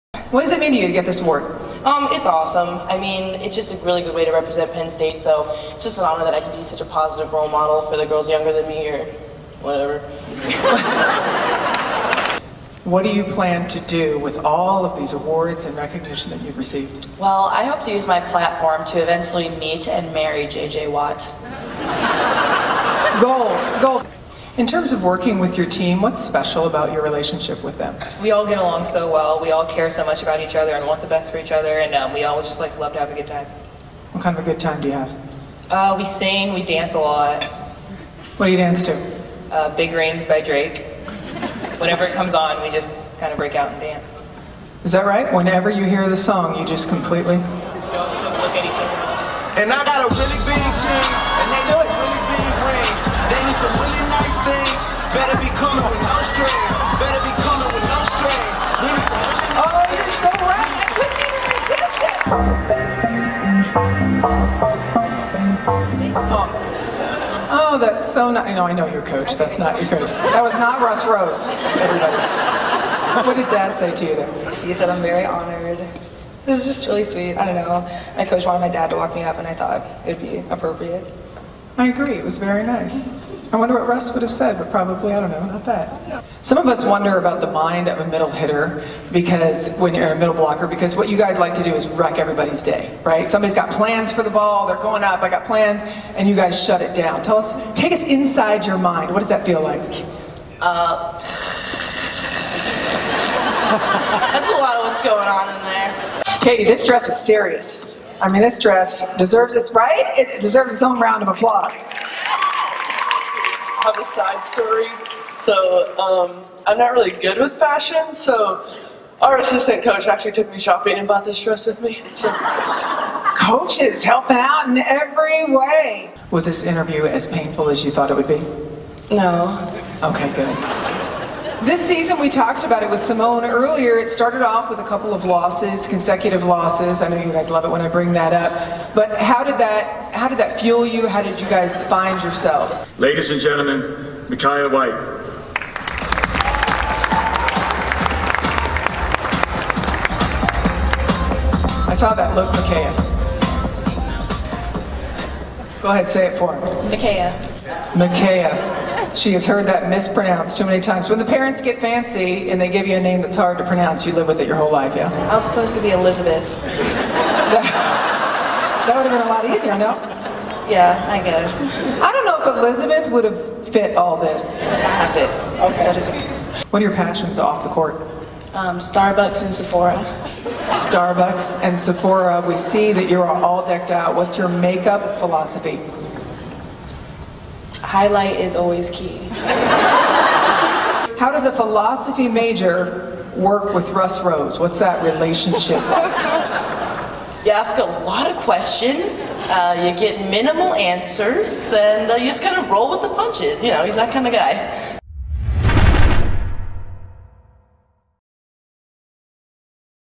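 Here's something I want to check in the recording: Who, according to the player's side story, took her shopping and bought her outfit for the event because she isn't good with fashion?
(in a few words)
assistant coach.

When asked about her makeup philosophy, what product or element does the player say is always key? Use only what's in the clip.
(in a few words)
Highlight.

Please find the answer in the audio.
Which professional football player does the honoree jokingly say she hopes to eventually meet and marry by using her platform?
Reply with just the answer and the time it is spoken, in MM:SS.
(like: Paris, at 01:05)
J.J. Watt, at 00:20.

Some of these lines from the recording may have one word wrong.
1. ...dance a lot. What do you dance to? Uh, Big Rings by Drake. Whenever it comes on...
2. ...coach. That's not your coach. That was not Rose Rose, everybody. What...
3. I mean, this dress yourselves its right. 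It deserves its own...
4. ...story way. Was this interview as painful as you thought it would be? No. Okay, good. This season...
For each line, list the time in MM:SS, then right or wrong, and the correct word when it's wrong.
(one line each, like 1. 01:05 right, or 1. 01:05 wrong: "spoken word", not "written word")
1. 00:36 right
2. 01:09 wrong: "Russ", not "Rose"
3. 01:48 wrong: "deserves", not "yourselves"
4. 02:04 wrong: "every", not "story".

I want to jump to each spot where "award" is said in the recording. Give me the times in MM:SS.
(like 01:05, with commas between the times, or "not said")
00:01, 00:15.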